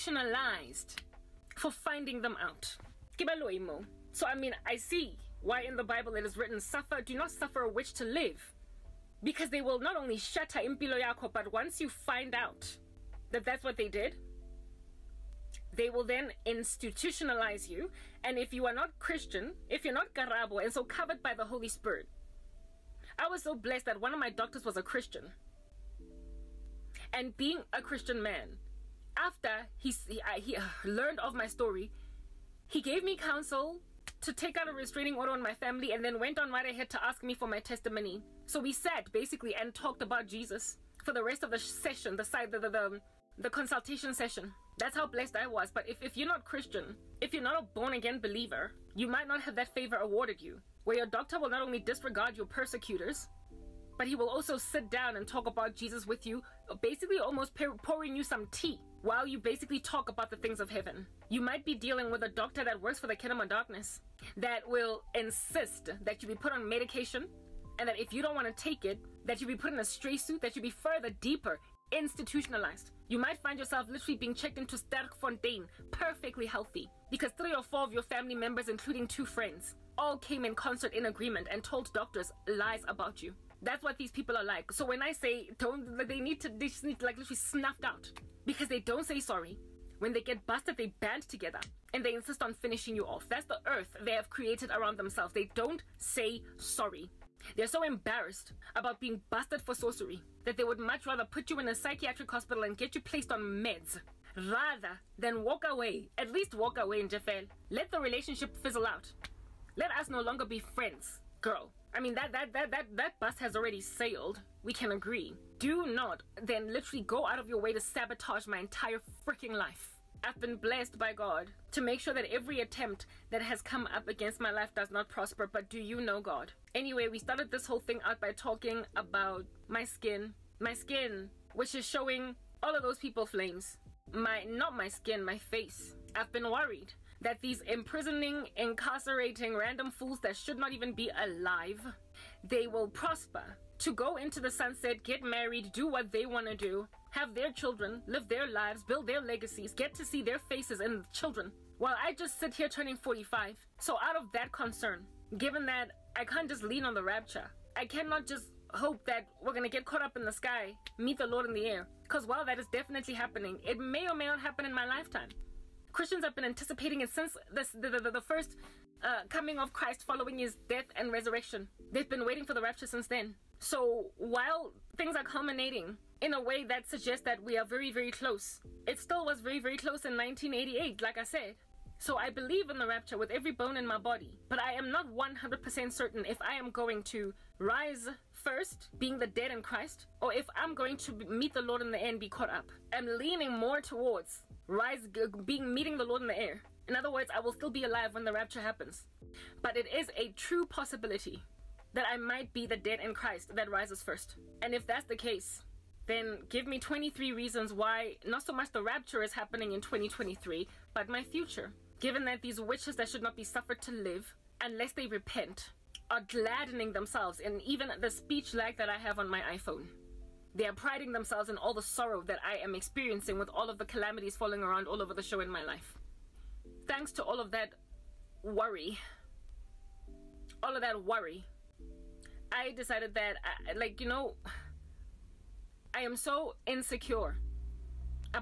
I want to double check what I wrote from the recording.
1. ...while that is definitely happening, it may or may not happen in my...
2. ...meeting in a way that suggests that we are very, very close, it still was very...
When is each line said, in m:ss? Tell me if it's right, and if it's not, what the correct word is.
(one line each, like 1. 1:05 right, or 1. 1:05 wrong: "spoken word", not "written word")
1. 2:42 right
2. 2:55 wrong: "culminating", not "meeting".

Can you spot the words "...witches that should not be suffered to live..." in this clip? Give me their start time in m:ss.
3:32.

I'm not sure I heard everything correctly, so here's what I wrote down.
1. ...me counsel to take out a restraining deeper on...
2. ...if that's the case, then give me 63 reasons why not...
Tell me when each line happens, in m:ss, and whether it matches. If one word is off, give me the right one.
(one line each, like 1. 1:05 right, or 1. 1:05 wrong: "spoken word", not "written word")
1. 0:33 wrong: "order", not "deeper"
2. 3:24 wrong: "23", not "63".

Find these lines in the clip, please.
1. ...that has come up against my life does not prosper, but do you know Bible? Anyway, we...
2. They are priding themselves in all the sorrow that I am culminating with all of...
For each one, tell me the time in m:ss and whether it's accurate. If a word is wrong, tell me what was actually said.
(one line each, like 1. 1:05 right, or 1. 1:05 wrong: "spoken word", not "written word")
1. 2:03 wrong: "God", not "Bible"
2. 3:40 wrong: "experiencing", not "culminating".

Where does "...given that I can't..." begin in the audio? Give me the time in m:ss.
2:35.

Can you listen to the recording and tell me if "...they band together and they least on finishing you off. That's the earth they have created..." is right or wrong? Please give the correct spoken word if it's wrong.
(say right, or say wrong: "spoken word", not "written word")
wrong: "insist", not "least".